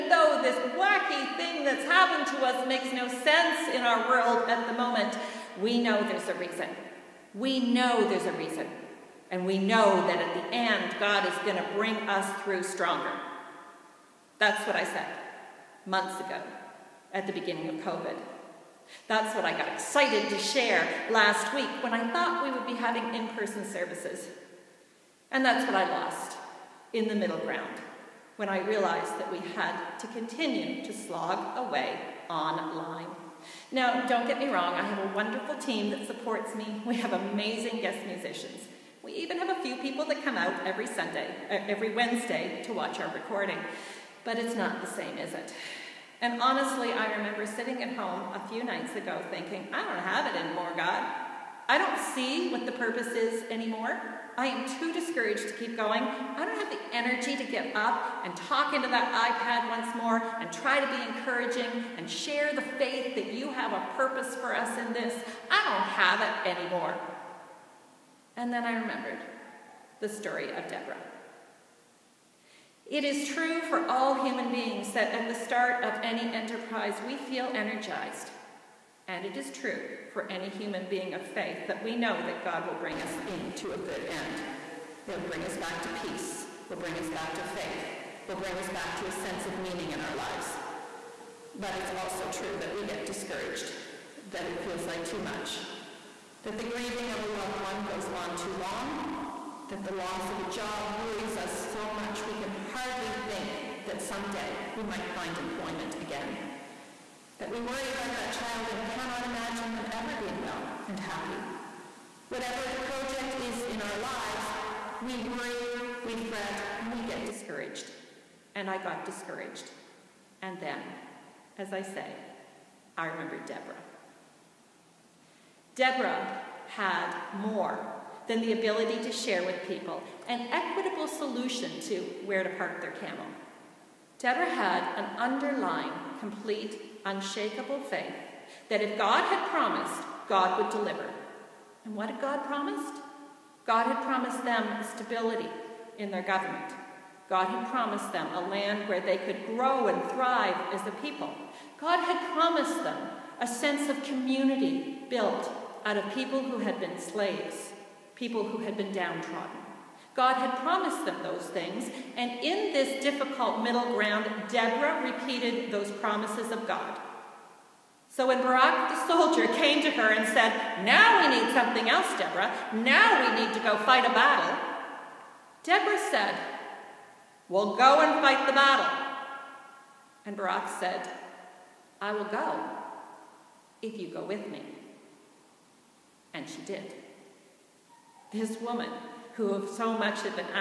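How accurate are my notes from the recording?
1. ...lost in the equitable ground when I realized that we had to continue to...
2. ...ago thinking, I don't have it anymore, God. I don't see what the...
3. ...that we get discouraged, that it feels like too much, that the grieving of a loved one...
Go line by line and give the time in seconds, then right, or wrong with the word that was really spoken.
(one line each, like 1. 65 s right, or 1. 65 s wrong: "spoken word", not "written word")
1. 25 s wrong: "middle", not "equitable"
2. 48 s right
3. 92 s right.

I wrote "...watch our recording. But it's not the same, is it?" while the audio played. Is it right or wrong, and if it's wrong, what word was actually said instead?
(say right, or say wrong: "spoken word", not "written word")
right.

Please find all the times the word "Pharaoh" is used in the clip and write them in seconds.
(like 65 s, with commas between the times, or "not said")
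not said.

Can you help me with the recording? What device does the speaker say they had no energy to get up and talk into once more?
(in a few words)
iPad.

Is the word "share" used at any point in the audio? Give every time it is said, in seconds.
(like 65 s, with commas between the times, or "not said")
20 s, 62 s, 129 s.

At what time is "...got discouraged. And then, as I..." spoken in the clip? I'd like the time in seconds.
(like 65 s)
118 s.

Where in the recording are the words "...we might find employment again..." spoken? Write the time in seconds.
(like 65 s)
104 s.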